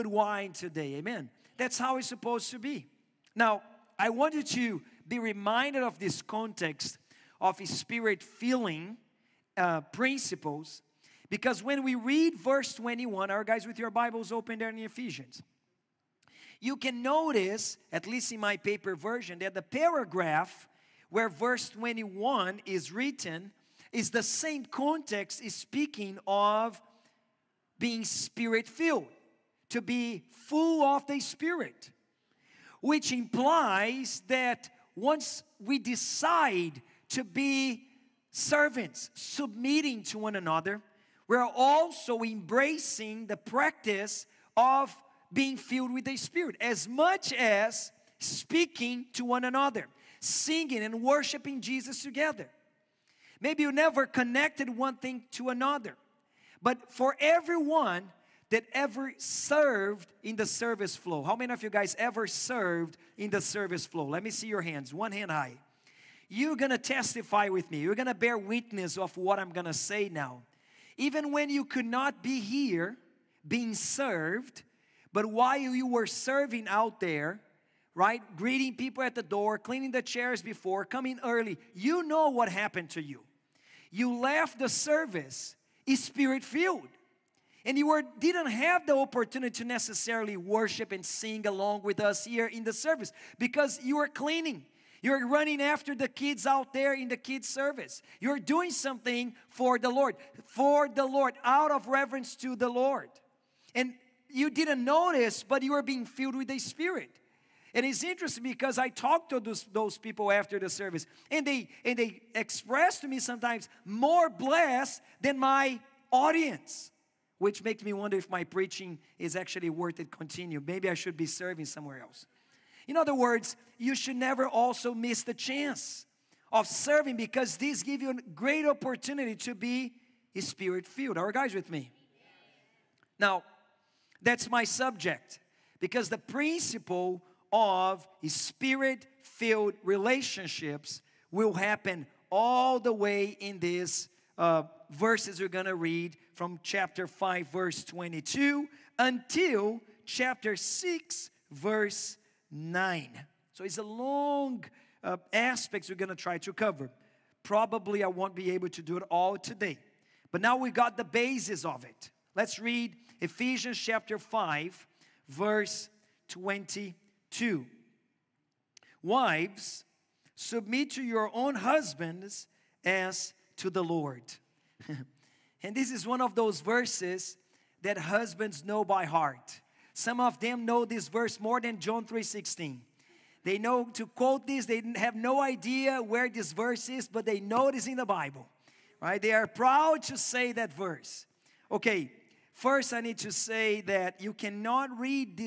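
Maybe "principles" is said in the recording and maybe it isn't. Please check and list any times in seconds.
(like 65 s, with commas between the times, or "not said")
9 s, 136 s.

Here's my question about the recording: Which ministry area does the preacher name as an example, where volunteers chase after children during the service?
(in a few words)
kids' service.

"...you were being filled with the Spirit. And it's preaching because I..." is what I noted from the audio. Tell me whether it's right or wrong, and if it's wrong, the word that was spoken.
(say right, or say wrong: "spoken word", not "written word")
wrong: "interesting", not "preaching".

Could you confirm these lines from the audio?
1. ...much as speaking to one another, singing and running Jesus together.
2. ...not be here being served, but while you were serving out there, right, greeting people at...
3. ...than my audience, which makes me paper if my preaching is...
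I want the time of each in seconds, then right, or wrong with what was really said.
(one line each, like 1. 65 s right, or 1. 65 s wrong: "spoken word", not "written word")
1. 46 s wrong: "worshiping", not "running"
2. 71 s right
3. 115 s wrong: "wonder", not "paper".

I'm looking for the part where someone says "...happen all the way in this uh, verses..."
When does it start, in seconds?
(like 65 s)
141 s.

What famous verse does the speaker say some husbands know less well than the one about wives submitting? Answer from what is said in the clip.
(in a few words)
John 3:16.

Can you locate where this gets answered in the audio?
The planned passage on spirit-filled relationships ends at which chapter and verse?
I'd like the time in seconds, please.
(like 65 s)
151 s.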